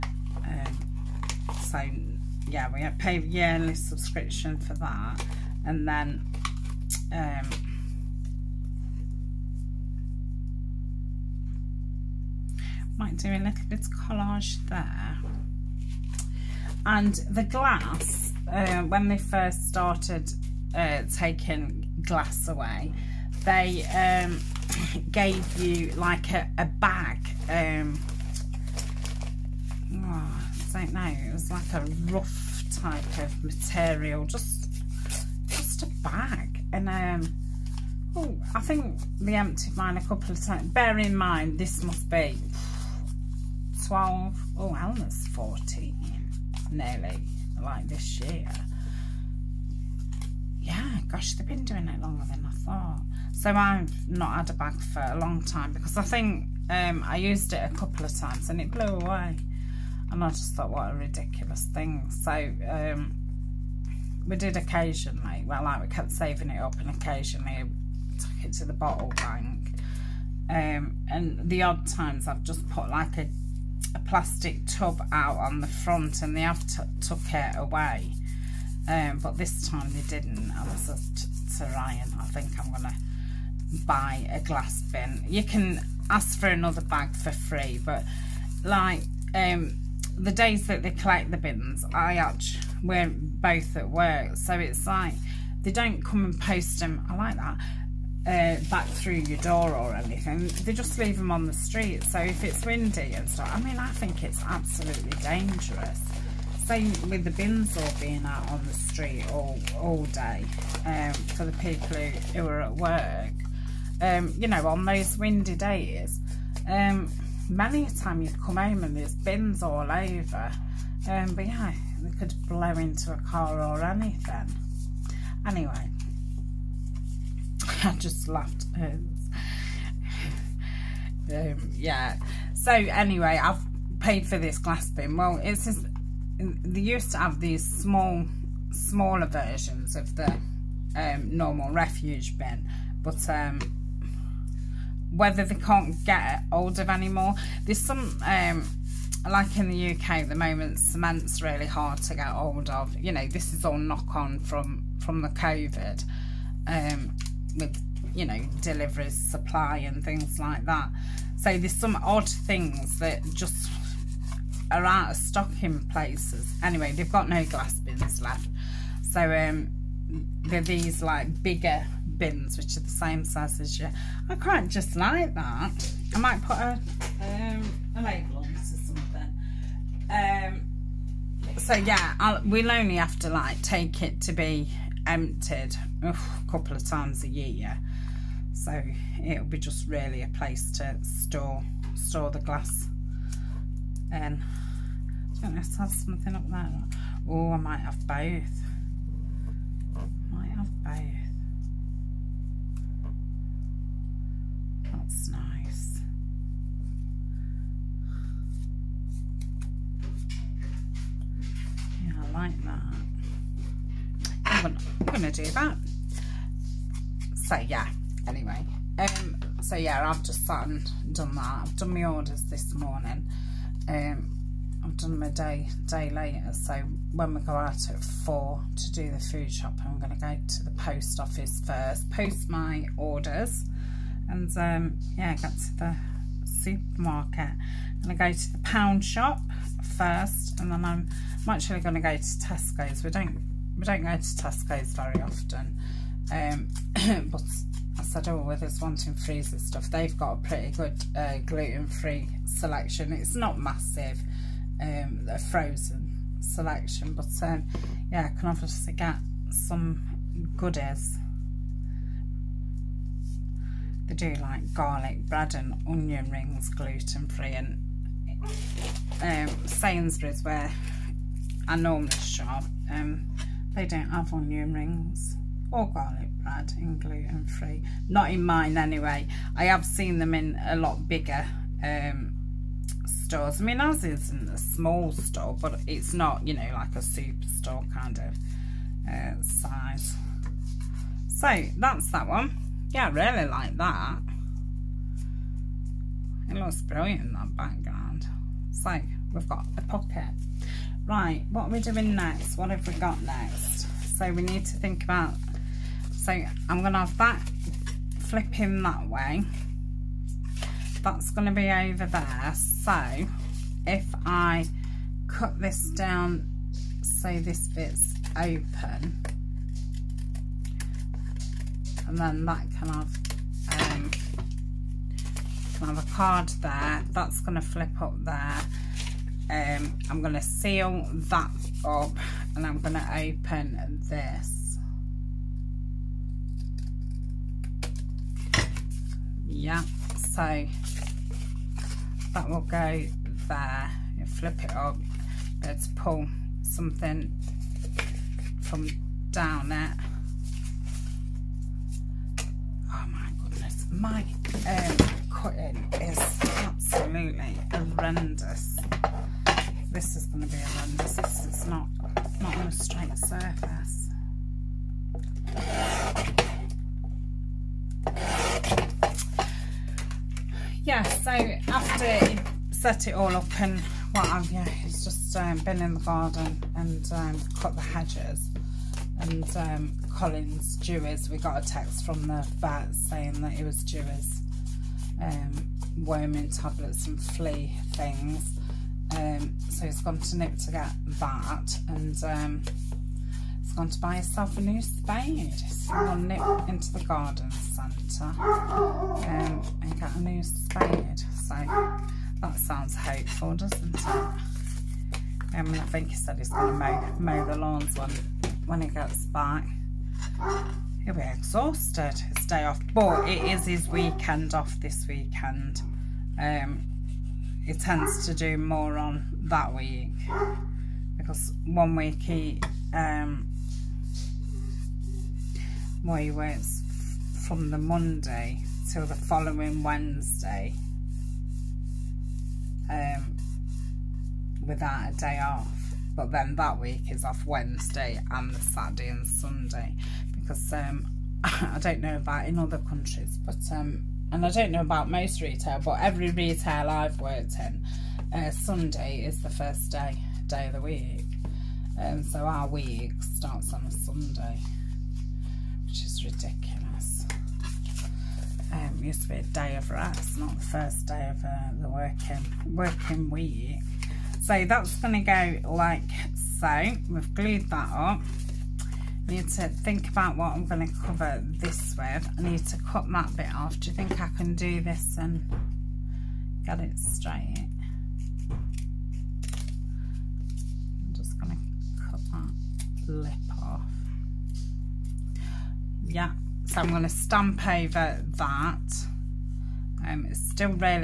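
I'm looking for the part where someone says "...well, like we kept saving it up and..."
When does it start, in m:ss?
1:05.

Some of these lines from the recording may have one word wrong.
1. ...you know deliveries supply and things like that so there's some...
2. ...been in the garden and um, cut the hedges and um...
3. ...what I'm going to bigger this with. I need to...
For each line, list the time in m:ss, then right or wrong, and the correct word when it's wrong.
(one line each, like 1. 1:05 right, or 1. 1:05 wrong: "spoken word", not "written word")
1. 2:38 right
2. 6:15 right
3. 7:50 wrong: "cover", not "bigger".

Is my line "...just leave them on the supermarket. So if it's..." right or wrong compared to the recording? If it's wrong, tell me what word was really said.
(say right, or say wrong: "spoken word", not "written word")
wrong: "street", not "supermarket".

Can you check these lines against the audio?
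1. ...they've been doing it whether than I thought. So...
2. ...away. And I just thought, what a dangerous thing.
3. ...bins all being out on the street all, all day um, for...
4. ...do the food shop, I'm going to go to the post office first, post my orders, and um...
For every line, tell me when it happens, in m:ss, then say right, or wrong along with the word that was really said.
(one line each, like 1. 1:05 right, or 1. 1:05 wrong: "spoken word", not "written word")
1. 0:51 wrong: "longer", not "whether"
2. 0:58 wrong: "ridiculous", not "dangerous"
3. 1:47 right
4. 3:48 right.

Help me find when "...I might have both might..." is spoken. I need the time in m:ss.
3:17.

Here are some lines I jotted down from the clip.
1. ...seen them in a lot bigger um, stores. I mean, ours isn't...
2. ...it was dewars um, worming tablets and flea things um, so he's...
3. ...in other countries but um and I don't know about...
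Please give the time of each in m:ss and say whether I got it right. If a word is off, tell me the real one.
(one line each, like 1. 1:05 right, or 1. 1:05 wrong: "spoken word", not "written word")
1. 4:39 right
2. 6:23 right
3. 7:22 right.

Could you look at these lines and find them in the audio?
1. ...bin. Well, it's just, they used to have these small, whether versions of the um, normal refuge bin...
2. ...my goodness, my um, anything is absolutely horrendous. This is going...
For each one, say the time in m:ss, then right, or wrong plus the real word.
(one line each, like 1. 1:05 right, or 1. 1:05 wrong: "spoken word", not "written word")
1. 2:14 wrong: "smaller", not "whether"
2. 5:53 wrong: "cutting", not "anything".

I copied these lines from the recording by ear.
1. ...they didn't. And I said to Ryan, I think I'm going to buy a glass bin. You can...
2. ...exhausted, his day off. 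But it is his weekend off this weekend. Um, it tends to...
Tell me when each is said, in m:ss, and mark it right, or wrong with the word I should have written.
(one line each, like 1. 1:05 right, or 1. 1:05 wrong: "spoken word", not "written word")
1. 1:19 right
2. 6:51 right.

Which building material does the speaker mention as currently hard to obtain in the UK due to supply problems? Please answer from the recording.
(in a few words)
cement.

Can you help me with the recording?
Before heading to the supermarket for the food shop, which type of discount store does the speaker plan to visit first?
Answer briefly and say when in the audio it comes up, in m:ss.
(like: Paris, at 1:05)
the pound shop, at 3:58.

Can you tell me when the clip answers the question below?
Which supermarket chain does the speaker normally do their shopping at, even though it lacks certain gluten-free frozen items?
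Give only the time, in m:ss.
4:29.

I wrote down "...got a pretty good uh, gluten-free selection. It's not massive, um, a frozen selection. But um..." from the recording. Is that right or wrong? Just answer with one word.
right.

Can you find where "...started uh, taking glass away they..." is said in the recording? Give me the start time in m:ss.
0:19.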